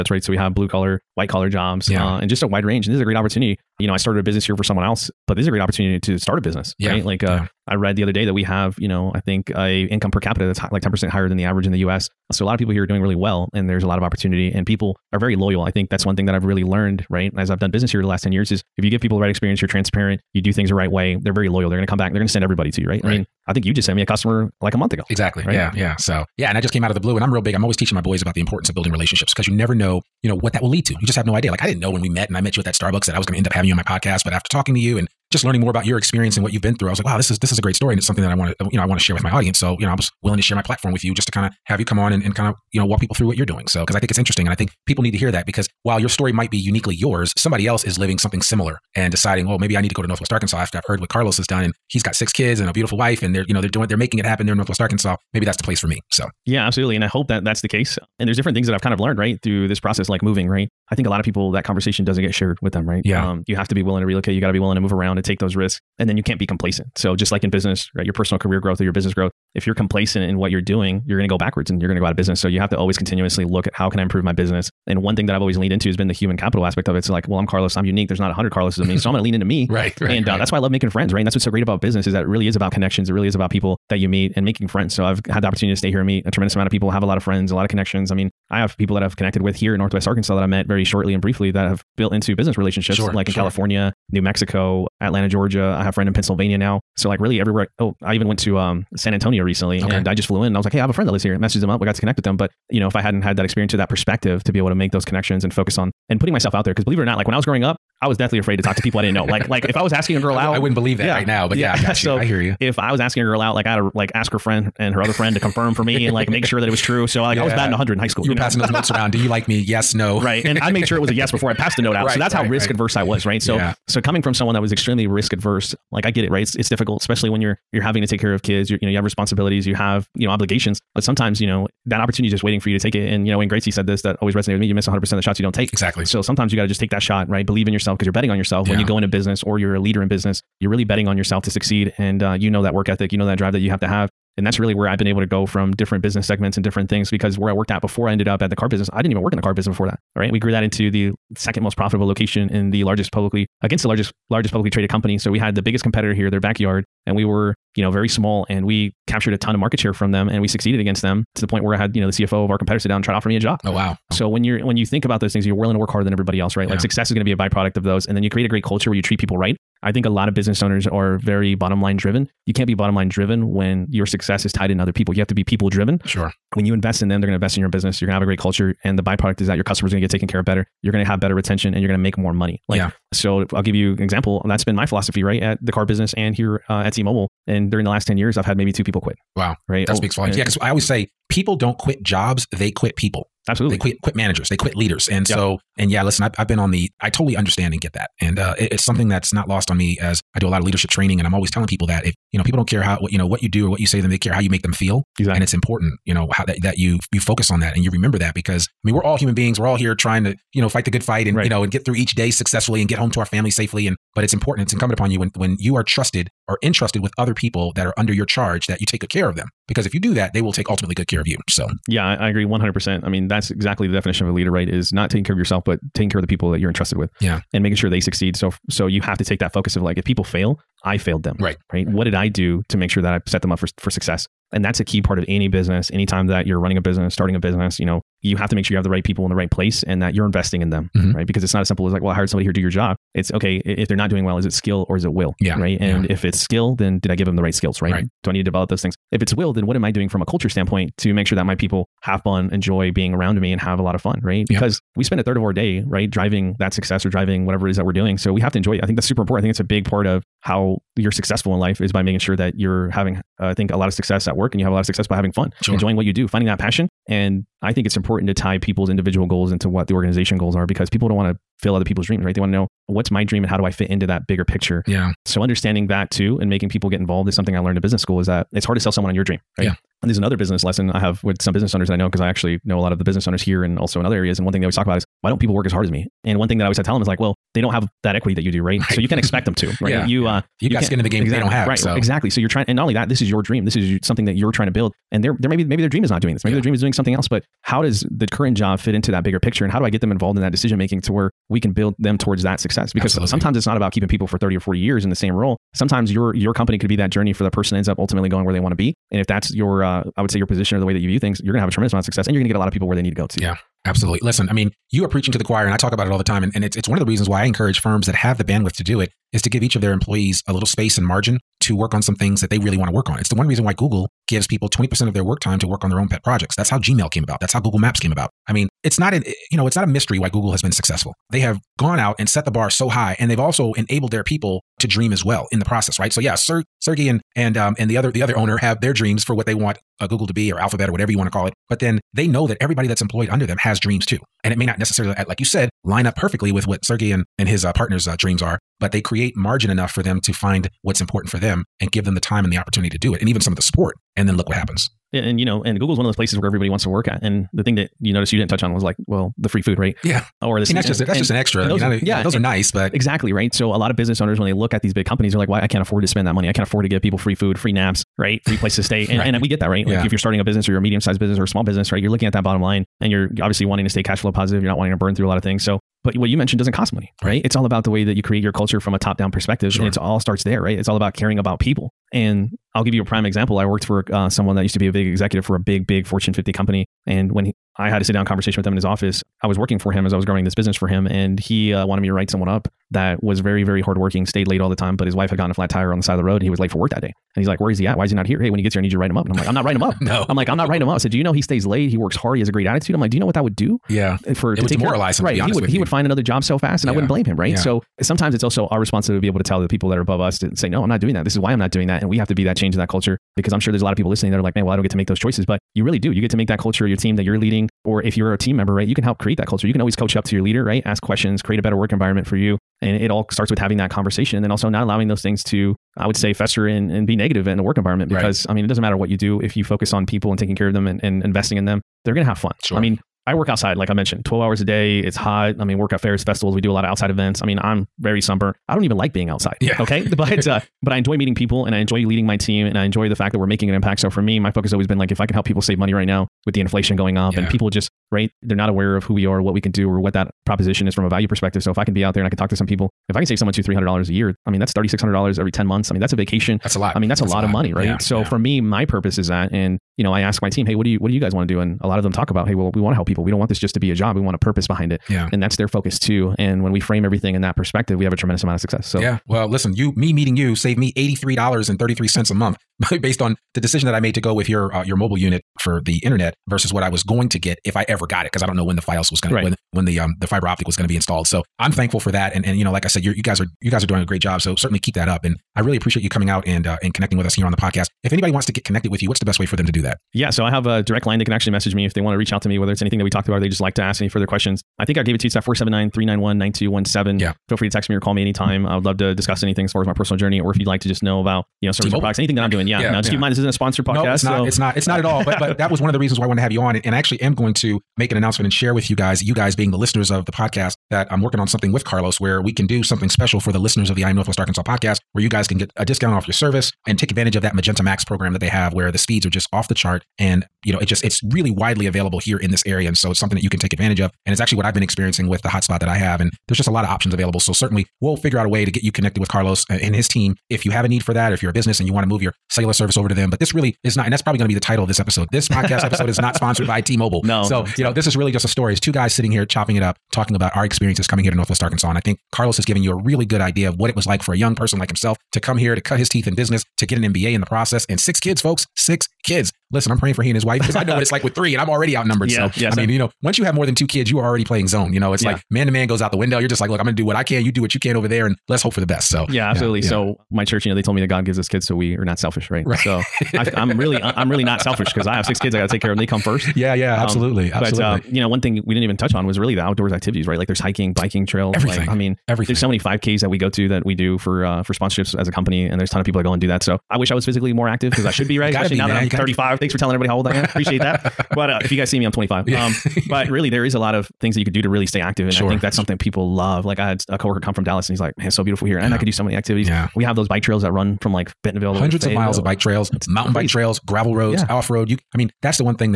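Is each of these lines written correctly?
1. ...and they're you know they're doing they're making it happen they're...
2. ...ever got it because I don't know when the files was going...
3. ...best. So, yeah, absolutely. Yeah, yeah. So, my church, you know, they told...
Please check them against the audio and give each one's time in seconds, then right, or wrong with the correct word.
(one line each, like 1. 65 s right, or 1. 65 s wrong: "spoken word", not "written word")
1. 53 s right
2. 477 s right
3. 558 s right.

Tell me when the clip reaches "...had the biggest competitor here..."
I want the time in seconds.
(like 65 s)
155 s.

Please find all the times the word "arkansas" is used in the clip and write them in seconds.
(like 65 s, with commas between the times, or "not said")
50 s, 54 s, 90 s, 514 s, 541 s.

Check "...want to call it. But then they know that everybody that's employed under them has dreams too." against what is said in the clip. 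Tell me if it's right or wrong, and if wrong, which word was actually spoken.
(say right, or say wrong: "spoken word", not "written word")
right.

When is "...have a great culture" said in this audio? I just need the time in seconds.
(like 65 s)
178 s.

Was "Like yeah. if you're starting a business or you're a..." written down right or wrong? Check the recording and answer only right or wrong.
right.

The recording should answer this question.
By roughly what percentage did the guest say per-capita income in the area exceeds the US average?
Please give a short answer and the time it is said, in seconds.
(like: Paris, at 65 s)
10%, at 10 s.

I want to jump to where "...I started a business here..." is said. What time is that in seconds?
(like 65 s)
3 s.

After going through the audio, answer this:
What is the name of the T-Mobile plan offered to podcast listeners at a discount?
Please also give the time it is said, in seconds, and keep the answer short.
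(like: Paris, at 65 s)
Magenta Max, at 517 s.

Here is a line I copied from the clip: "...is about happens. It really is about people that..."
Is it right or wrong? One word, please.
wrong.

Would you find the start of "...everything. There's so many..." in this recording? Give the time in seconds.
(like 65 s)
572 s.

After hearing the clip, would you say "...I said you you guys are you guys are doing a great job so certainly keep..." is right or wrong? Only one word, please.
right.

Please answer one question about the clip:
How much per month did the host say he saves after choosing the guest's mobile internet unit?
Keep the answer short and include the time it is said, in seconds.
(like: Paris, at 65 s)
$83.33, at 470 s.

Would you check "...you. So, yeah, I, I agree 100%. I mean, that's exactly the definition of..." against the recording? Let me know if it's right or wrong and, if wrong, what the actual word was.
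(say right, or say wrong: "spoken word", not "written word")
right.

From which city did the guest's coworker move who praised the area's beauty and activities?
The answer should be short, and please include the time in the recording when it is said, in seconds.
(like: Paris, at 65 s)
Dallas, at 587 s.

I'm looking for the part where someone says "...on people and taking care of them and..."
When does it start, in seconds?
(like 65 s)
429 s.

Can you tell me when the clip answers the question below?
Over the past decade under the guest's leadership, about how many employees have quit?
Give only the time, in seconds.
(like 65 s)
188 s.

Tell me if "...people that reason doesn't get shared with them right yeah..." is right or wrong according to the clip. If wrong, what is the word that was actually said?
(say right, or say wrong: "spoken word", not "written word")
wrong: "conversation", not "reason".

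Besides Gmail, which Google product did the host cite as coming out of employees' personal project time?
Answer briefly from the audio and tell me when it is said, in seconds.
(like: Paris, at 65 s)
Google Maps, at 327 s.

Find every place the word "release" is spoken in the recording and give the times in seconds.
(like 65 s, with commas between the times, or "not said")
not said.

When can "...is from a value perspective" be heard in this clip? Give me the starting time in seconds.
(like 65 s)
450 s.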